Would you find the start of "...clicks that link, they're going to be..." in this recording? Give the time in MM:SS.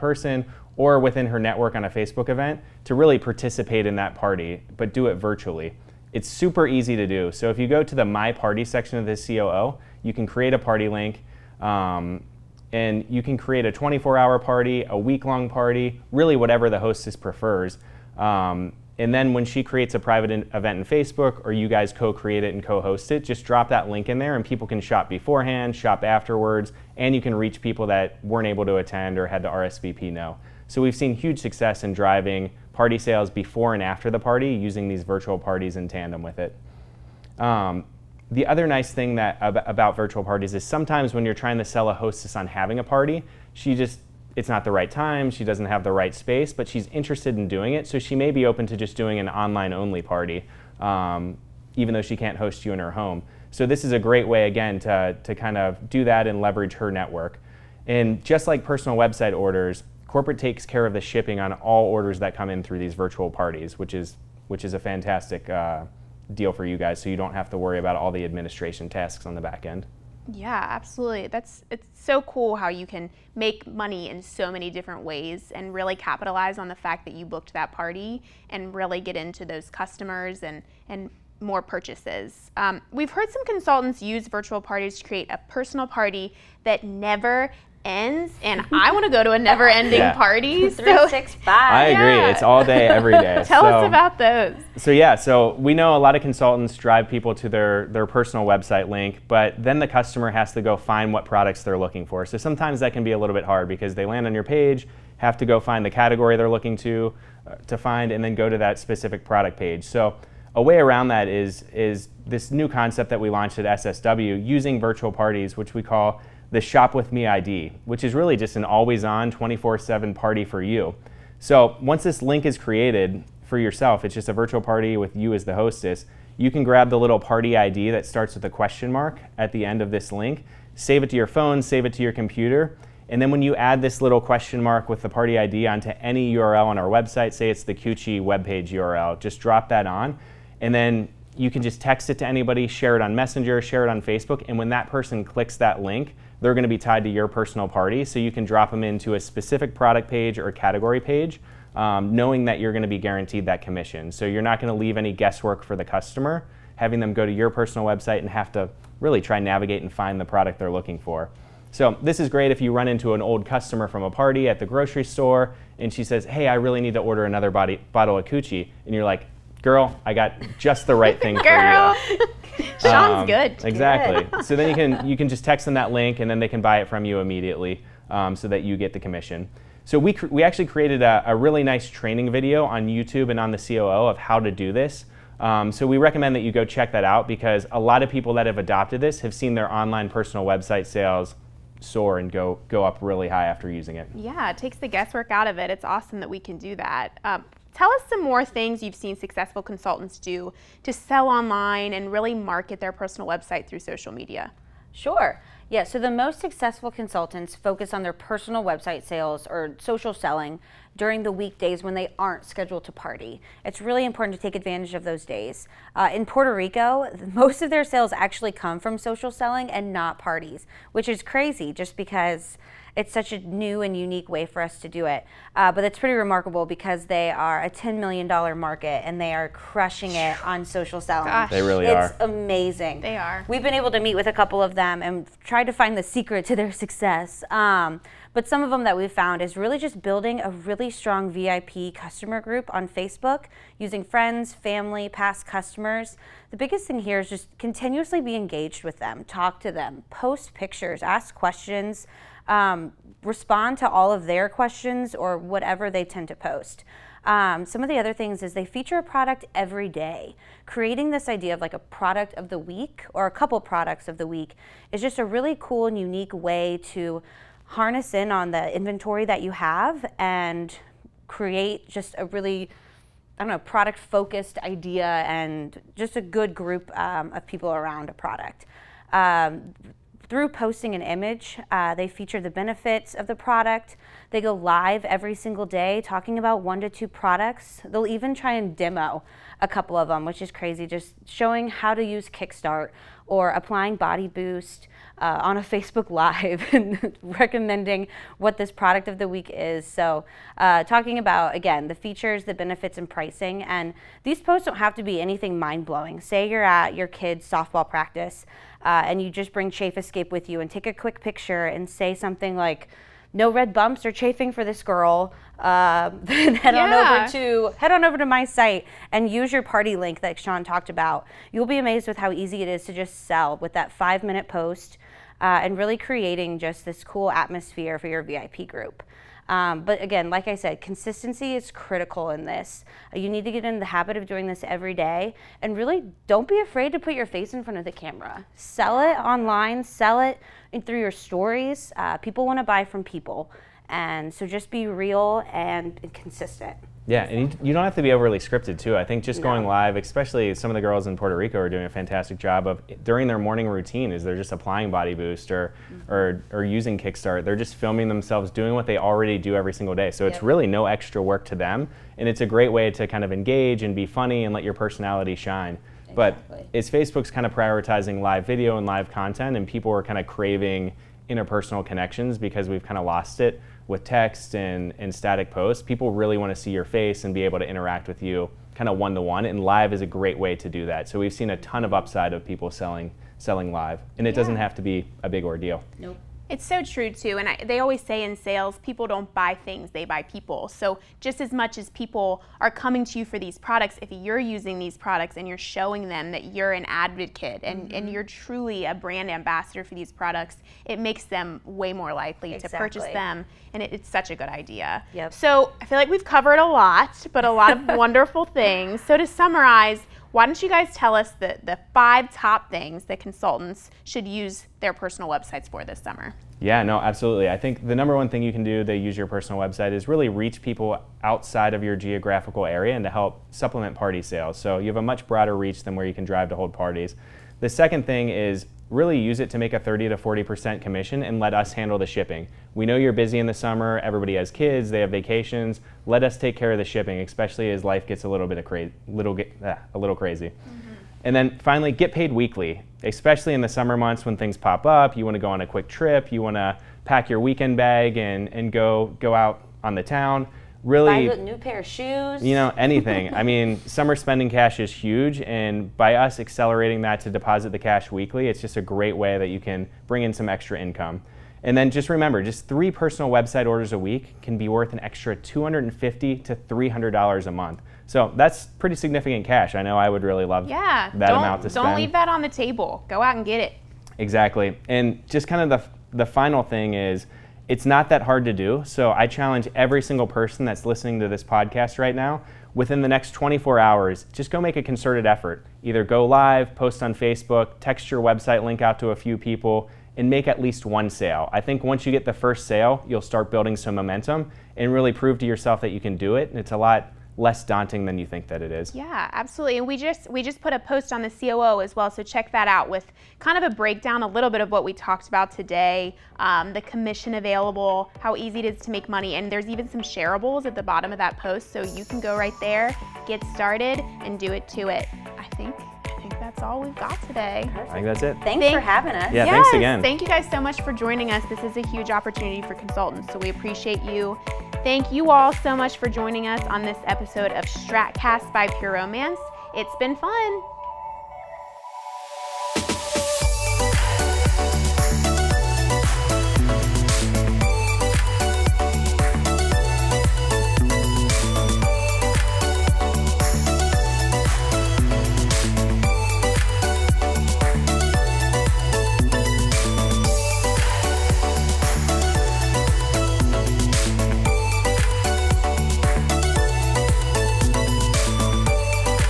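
02:25.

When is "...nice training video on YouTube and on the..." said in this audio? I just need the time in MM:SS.
03:01.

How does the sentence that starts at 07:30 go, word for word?
Really, buy a new pair of shoes.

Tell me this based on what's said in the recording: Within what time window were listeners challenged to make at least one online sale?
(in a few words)
24 hours.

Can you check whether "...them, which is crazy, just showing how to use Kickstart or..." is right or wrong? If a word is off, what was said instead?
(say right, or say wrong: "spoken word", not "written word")
right.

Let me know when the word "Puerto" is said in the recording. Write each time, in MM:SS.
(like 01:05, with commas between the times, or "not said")
03:36, 05:51.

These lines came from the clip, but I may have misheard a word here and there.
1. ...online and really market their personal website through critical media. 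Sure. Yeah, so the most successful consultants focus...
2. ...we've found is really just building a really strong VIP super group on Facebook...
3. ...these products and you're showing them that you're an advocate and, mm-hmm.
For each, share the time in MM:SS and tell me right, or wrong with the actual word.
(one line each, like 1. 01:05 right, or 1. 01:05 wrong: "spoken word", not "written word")
1. 03:21 wrong: "social", not "critical"
2. 03:58 wrong: "customer", not "super"
3. 06:34 right.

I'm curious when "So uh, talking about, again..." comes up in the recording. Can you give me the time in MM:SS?
04:59.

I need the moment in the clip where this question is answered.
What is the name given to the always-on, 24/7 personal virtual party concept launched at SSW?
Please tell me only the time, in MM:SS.
01:56.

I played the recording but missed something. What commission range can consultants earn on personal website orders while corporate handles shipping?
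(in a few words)
30 to 40%.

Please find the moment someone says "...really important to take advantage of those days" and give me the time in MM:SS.
03:33.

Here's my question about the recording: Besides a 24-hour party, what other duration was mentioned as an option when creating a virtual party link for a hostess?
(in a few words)
Week long.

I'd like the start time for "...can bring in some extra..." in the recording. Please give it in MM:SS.
07:39.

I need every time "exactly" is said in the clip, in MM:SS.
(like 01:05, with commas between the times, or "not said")
02:53, 06:06, 06:42, 07:54.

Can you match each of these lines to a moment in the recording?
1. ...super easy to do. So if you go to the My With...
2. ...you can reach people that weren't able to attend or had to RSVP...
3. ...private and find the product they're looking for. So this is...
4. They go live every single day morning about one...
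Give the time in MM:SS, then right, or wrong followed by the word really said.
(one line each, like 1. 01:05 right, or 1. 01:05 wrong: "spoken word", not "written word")
1. 00:06 wrong: "Party", not "With"
2. 00:27 right
3. 02:39 wrong: "navigate", not "private"
4. 04:44 wrong: "talking", not "morning".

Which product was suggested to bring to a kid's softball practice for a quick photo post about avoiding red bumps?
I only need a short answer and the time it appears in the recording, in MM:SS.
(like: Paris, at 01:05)
Chafe Escape, at 05:09.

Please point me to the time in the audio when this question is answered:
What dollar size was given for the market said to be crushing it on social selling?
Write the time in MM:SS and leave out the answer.
03:47.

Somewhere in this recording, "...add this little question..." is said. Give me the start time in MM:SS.
02:13.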